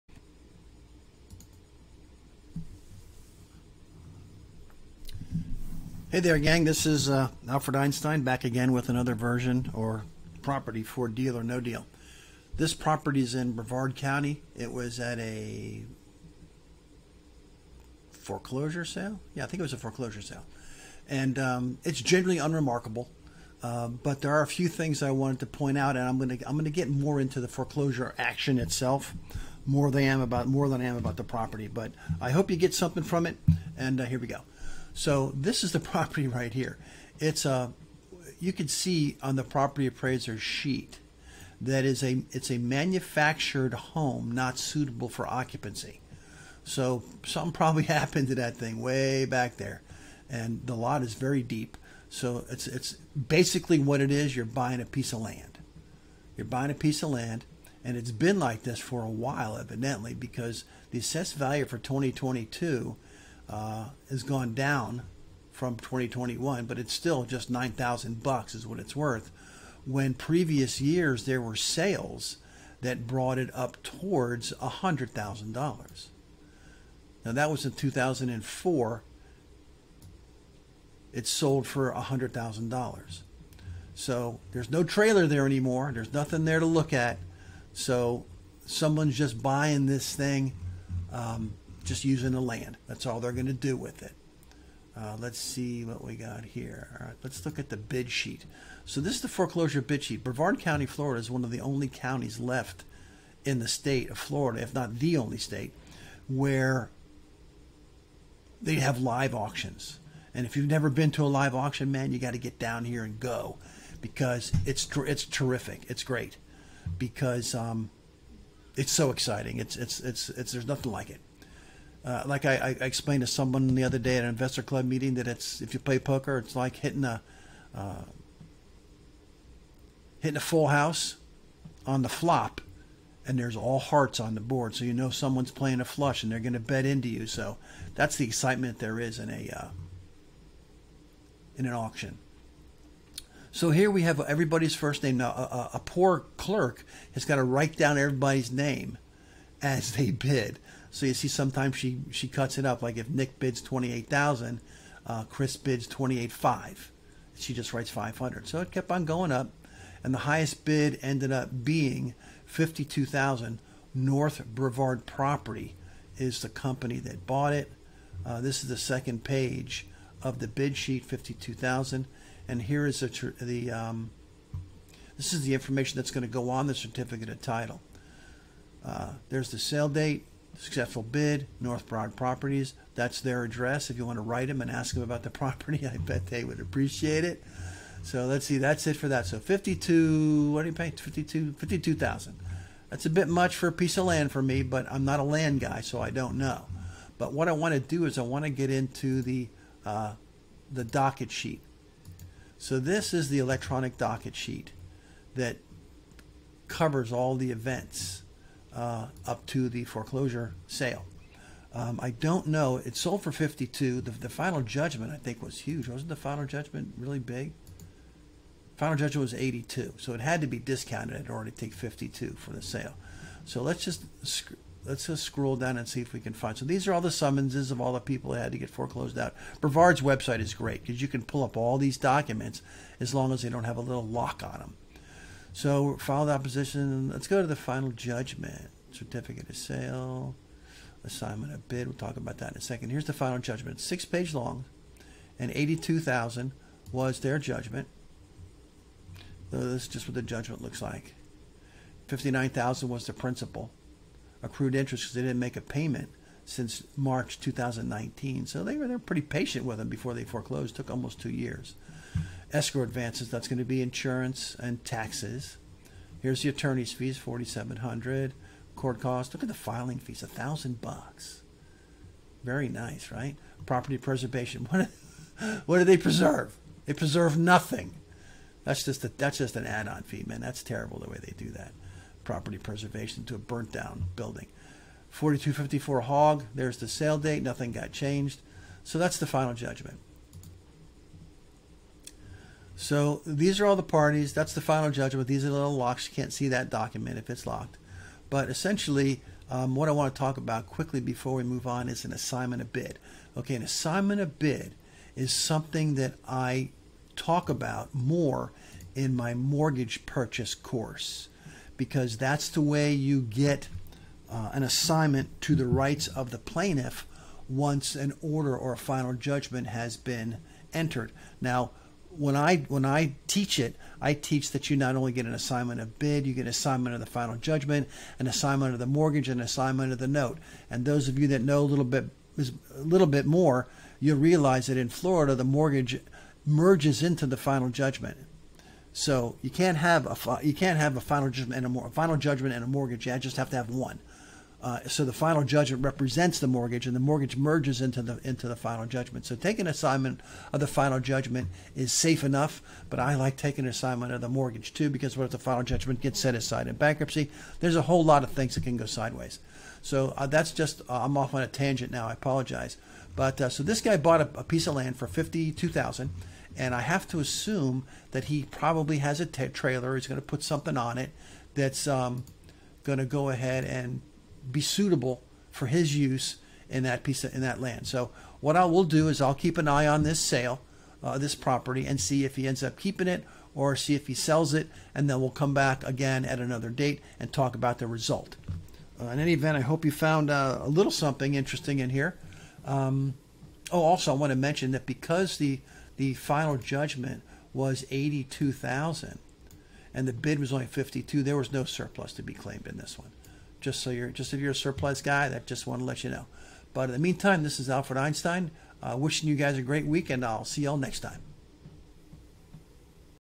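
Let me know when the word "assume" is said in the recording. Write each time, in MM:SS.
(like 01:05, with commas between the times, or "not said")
06:07.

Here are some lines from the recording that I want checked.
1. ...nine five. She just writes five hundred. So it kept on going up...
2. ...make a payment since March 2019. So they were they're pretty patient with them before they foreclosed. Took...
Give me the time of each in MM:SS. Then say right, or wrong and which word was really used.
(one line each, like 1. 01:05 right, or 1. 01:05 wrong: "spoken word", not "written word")
1. 02:36 wrong: "eight", not "nine"
2. 04:15 right.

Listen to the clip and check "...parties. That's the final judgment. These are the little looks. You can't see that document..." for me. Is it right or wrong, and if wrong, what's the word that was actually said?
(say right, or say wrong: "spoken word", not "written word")
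wrong: "locks", not "looks".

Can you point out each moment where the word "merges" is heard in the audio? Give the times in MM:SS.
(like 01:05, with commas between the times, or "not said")
05:36, 05:47.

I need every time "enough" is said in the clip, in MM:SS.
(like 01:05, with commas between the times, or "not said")
05:52.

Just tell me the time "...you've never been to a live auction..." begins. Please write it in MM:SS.
01:50.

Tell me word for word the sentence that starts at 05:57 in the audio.
There's a whole lot of things that can go sideways.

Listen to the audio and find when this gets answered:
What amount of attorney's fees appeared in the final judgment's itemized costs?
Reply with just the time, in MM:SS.
04:27.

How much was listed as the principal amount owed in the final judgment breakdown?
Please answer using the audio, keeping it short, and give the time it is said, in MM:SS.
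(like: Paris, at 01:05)
$59,000, at 04:12.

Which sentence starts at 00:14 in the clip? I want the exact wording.
It was at a foreclosure sale.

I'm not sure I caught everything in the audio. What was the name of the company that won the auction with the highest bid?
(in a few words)
North Brevard Property.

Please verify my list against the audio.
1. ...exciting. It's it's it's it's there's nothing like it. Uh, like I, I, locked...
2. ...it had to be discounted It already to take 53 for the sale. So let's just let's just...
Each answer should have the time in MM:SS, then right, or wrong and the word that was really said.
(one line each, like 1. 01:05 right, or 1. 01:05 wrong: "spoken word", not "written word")
1. 01:59 wrong: "explained", not "locked"
2. 03:40 wrong: "52", not "53".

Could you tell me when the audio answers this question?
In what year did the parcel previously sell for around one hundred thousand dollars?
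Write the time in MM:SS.
01:17.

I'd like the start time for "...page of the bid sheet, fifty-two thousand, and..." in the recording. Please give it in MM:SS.
02:49.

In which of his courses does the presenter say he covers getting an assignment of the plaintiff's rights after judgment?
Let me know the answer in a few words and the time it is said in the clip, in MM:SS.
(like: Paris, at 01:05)
mortgage purchase course, at 05:09.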